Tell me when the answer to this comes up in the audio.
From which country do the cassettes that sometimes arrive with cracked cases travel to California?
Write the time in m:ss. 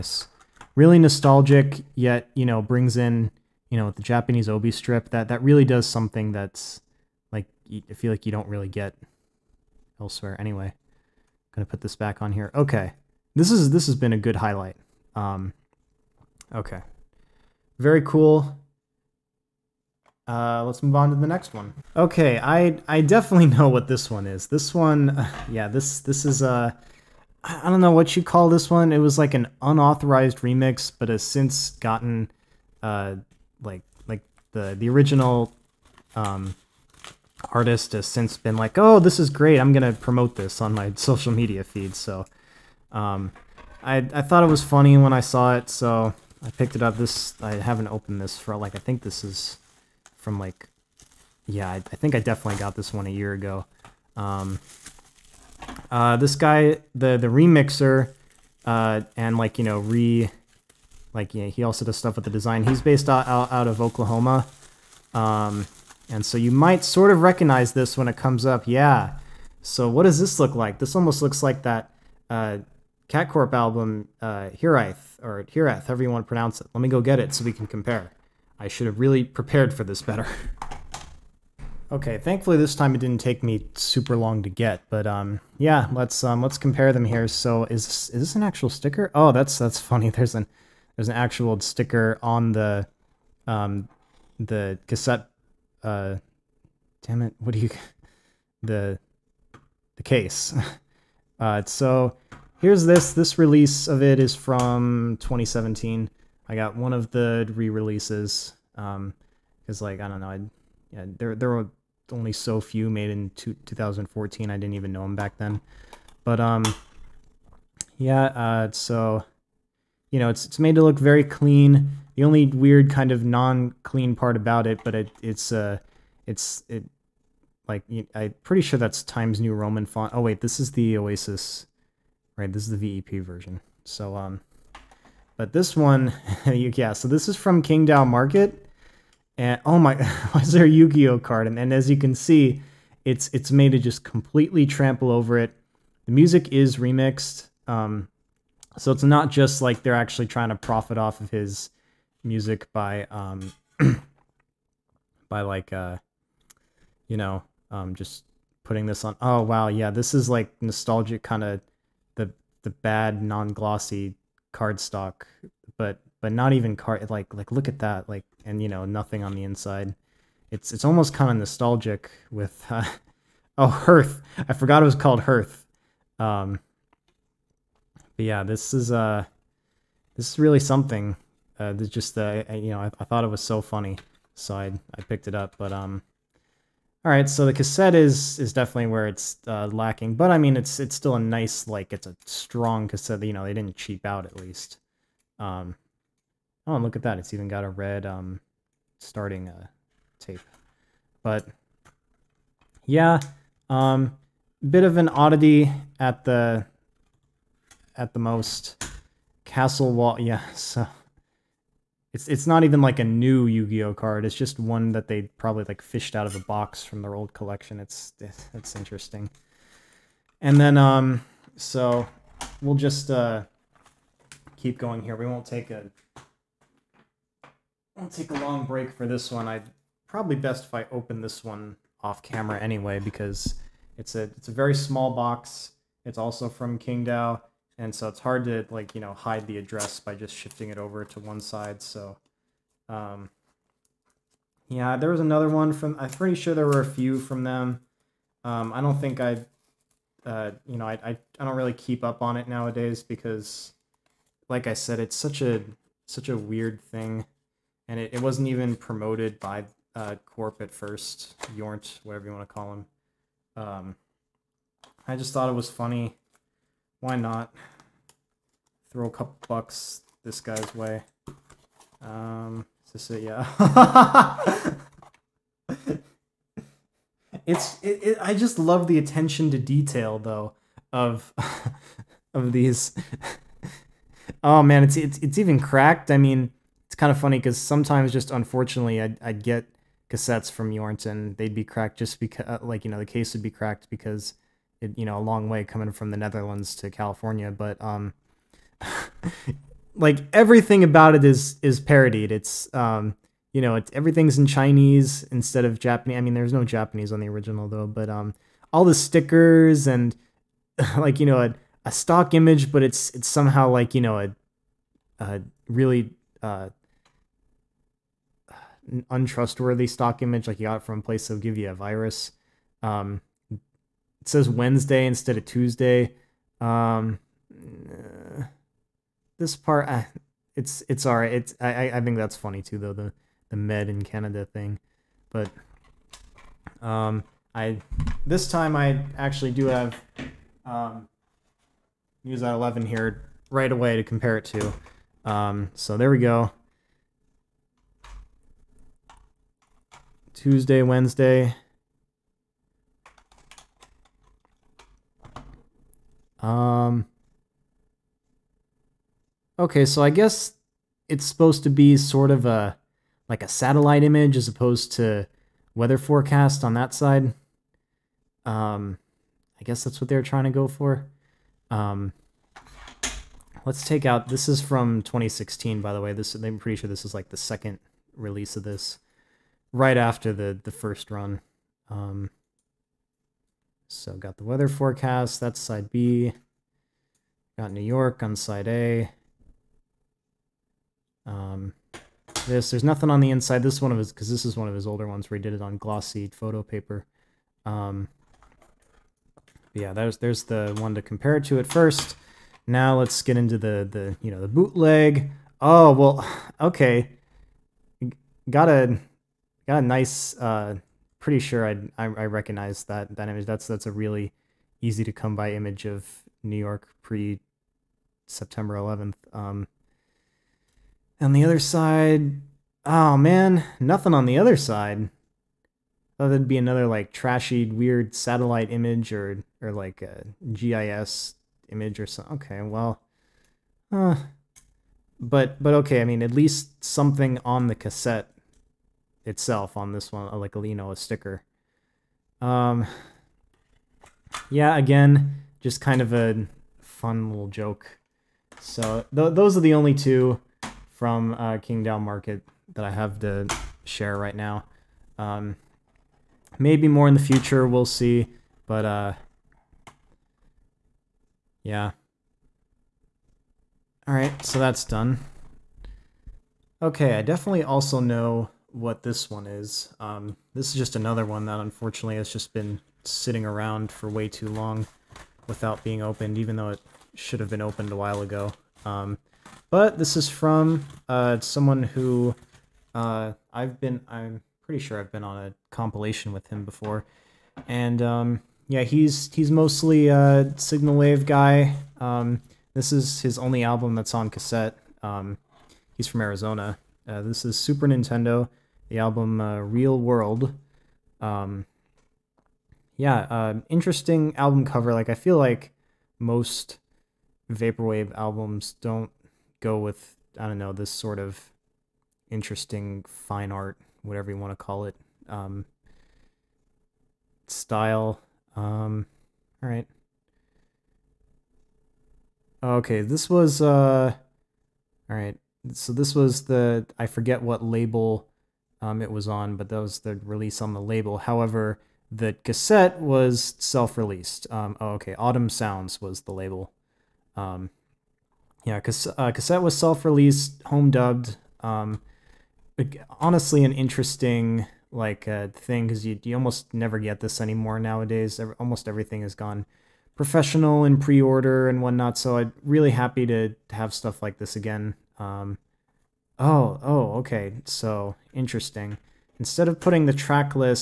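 4:56.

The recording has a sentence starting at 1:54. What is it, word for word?
I didn't even know them back then, but um, yeah.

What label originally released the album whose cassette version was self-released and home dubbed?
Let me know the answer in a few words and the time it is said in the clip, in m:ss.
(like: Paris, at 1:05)
Autumn Sounds, at 8:55.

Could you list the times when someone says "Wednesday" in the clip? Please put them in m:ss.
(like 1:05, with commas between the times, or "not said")
5:24, 5:50.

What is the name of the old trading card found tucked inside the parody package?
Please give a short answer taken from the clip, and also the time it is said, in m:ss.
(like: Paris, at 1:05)
Castle Wall, at 3:29.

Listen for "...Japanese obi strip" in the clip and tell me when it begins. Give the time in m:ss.
0:04.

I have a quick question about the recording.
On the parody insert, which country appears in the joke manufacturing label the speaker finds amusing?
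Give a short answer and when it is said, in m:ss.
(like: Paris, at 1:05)
Canada, at 5:34.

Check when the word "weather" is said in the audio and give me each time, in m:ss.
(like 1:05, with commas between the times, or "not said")
6:05, 6:24.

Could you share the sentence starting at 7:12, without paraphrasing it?
Okay, well, uh, but but okay.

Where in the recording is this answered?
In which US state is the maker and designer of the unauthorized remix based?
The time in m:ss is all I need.
1:03.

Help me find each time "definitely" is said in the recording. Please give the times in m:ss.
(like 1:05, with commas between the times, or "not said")
0:23, 0:52, 3:08, 7:47.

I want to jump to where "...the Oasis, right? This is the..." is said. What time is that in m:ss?
2:10.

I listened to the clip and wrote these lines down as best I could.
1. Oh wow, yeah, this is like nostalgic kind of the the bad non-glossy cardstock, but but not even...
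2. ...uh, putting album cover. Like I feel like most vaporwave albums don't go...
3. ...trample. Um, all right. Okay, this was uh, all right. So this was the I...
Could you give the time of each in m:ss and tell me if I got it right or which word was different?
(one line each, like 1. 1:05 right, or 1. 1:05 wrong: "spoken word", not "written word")
1. 2:39 right
2. 8:23 wrong: "interesting", not "putting"
3. 8:37 wrong: "style", not "trample".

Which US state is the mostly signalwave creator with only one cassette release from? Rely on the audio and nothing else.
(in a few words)
Arizona.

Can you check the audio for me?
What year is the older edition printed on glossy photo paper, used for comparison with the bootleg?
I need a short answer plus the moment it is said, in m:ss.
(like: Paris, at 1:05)
2016, at 6:15.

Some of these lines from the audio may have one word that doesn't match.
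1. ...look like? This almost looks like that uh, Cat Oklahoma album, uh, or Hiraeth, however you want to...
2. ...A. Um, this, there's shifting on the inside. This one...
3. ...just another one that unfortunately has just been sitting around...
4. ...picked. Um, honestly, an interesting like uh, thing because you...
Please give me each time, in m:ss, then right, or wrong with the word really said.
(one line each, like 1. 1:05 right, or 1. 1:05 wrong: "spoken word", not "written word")
1. 1:10 wrong: "Corp", not "Oklahoma"
2. 6:28 wrong: "nothing", not "shifting"
3. 7:50 right
4. 9:00 wrong: "dubbed", not "picked".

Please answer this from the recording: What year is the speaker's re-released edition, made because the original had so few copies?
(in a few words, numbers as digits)
2017.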